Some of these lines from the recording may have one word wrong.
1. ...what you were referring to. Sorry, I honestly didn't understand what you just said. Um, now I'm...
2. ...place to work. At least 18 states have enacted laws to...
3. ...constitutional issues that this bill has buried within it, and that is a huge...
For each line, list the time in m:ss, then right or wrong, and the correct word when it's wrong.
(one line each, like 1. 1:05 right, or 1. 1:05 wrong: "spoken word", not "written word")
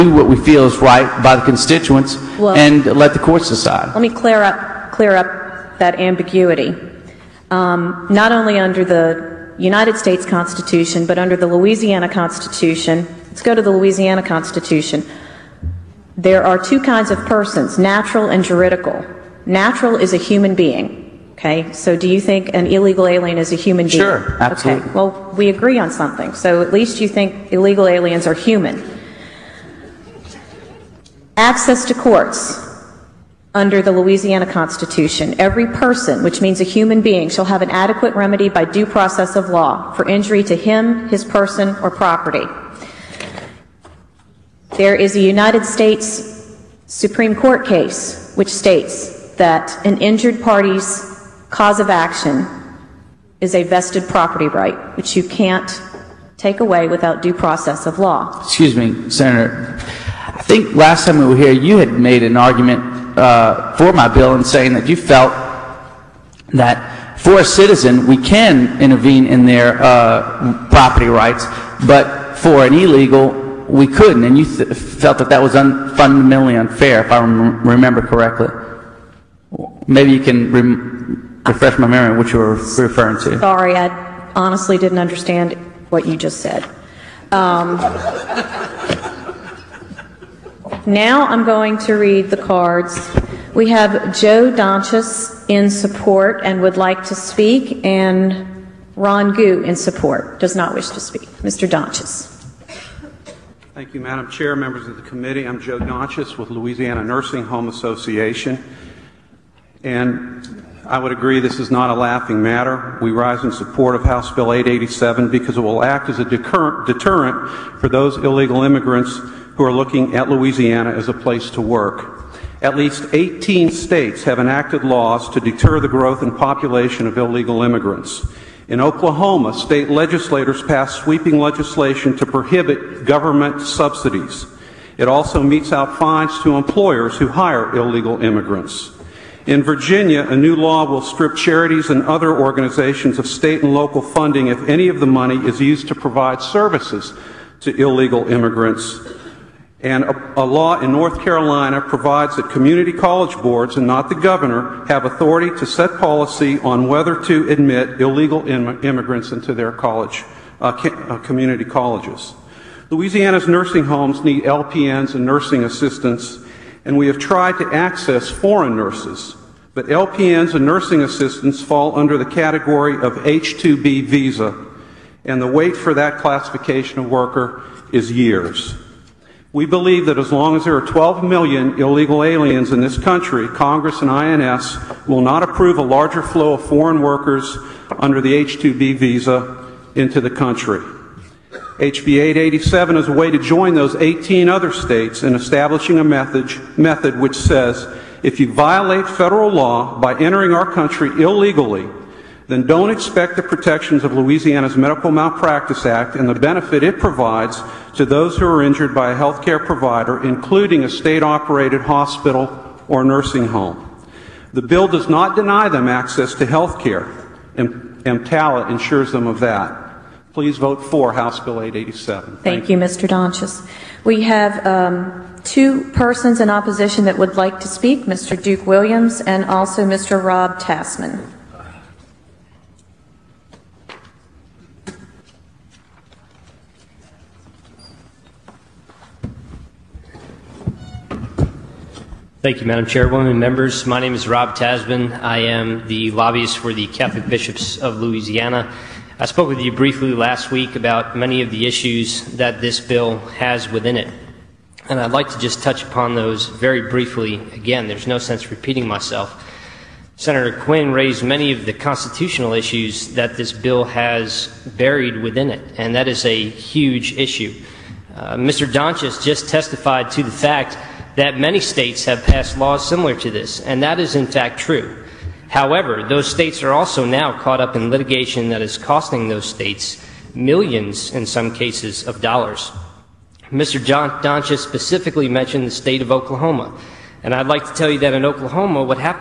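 1. 1:22 right
2. 2:01 right
3. 4:21 right.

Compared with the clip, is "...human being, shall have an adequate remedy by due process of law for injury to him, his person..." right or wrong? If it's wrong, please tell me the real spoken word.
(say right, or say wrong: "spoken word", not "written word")
right.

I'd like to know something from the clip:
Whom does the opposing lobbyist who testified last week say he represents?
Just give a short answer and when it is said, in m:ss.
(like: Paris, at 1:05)
the Catholic Bishops of Louisiana, at 4:06.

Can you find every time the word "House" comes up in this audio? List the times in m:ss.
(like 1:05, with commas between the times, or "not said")
1:54, 3:41.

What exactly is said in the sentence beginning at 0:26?
So at least you think illegal aliens are human.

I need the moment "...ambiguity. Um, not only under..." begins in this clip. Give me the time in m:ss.
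0:05.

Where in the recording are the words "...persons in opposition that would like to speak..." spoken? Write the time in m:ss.
3:45.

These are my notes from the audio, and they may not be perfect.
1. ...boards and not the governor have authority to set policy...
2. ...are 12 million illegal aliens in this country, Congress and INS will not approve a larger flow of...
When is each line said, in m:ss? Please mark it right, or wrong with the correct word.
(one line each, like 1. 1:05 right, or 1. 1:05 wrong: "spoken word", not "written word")
1. 2:33 right
2. 3:00 right.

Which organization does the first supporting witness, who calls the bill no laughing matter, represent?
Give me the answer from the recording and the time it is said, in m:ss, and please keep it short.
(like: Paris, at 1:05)
Louisiana Nursing Home Association, at 1:46.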